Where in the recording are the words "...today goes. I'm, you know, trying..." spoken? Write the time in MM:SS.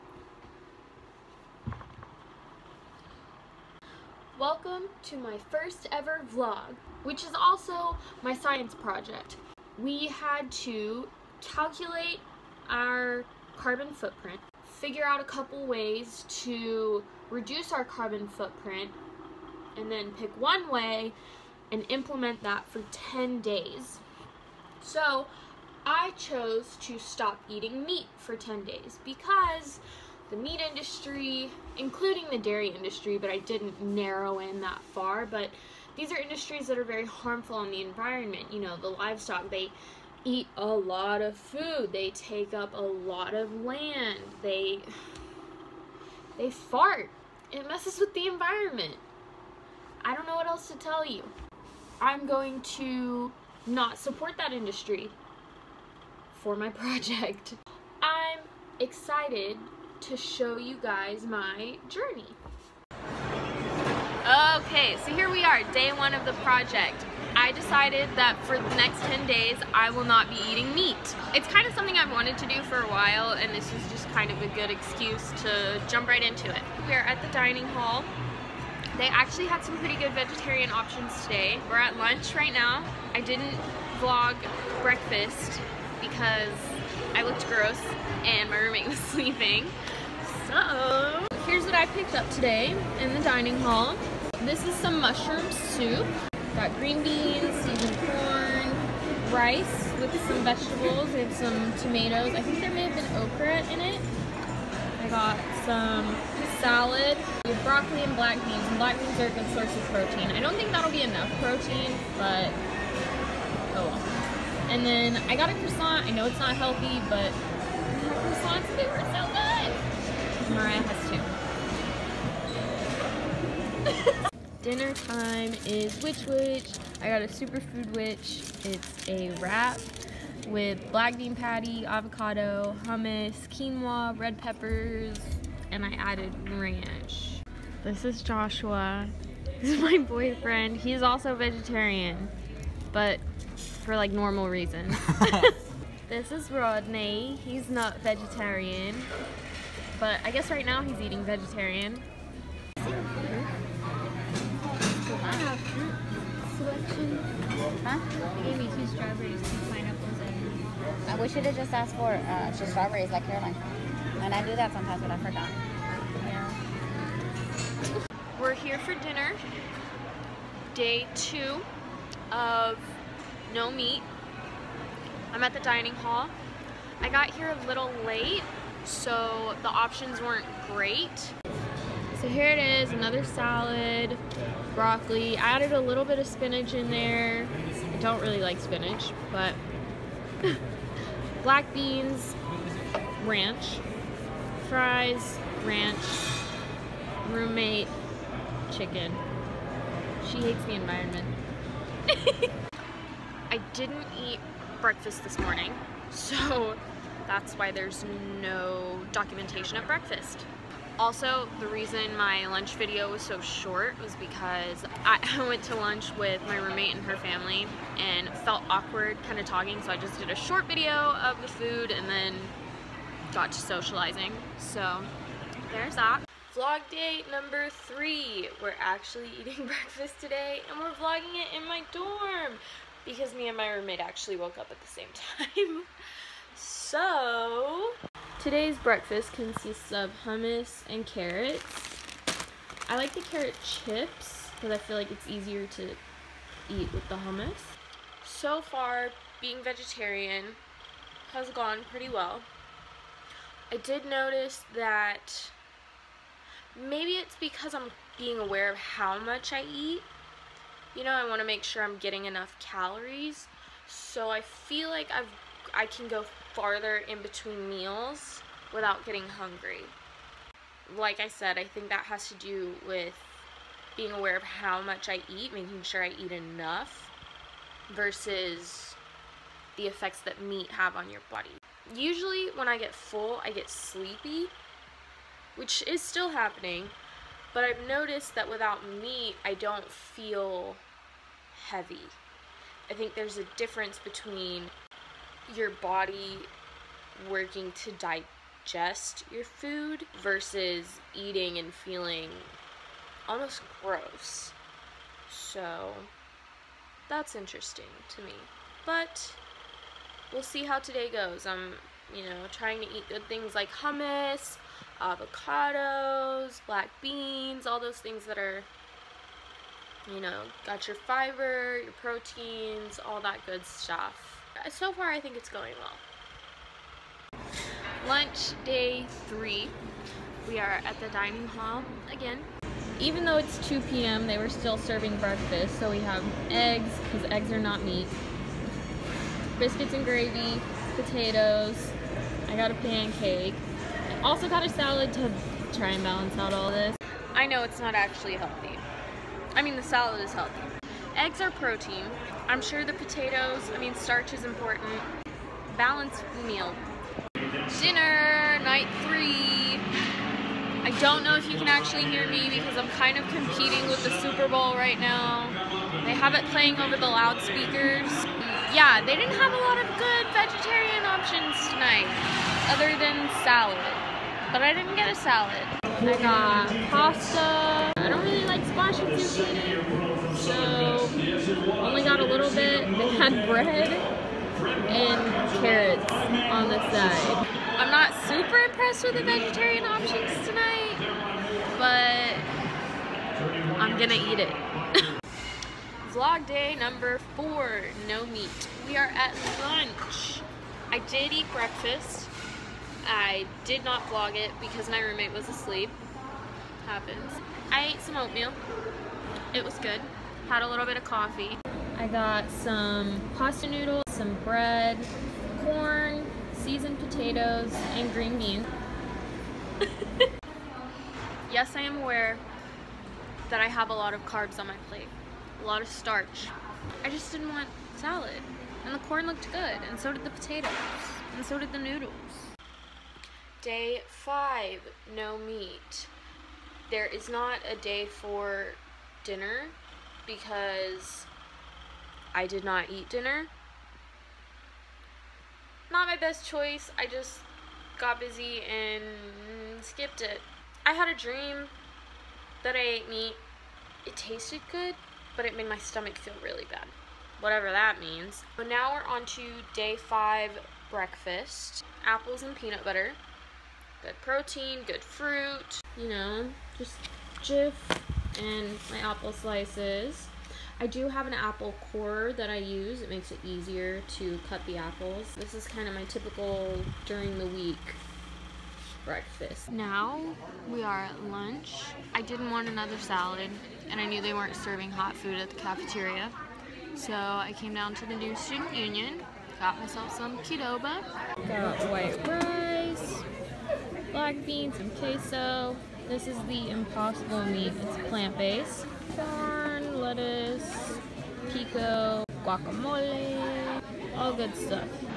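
05:10.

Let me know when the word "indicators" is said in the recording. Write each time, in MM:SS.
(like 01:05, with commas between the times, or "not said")
not said.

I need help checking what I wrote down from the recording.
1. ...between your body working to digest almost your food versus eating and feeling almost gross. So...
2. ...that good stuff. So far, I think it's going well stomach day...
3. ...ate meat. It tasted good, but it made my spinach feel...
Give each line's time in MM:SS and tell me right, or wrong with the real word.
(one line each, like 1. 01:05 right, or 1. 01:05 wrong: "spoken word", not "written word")
1. 04:54 wrong: "digest", not "almost"
2. 05:23 wrong: "lunch", not "stomach"
3. 07:32 wrong: "stomach", not "spinach".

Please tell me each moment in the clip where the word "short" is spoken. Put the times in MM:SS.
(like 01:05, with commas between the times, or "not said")
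03:33, 03:40.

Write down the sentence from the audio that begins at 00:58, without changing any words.
I'm excited to show you guys my journey.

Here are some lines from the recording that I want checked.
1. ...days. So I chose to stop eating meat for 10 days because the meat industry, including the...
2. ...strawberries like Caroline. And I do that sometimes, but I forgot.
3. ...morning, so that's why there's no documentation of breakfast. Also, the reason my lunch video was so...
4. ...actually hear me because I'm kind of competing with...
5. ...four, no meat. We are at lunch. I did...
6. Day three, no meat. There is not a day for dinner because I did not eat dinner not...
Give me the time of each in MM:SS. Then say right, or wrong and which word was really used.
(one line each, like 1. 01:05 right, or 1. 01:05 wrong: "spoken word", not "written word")
1. 00:23 right
2. 02:42 right
3. 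03:25 right
4. 06:01 right
5. 06:37 right
6. 07:13 wrong: "five", not "three".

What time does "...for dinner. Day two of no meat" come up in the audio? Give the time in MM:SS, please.
02:48.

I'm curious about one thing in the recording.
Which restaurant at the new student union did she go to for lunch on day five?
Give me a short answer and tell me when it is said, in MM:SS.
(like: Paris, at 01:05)
Qdoba, at 08:10.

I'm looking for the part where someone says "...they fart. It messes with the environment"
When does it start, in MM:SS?
00:46.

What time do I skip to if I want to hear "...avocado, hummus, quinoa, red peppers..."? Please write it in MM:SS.
02:11.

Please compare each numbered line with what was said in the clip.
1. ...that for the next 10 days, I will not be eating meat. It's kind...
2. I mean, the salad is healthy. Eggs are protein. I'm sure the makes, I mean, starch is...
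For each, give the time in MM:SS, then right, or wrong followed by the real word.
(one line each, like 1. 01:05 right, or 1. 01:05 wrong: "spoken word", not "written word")
1. 01:08 right
2. 05:49 wrong: "potatoes", not "makes".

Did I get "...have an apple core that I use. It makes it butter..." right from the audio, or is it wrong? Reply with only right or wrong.
wrong.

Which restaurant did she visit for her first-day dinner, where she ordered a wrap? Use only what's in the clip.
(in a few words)
Which Wich.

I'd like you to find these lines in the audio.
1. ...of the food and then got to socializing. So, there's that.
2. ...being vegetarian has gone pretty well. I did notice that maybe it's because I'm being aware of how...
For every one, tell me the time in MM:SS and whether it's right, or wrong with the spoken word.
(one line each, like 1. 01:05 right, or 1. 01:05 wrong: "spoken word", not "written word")
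1. 03:40 right
2. 04:09 right.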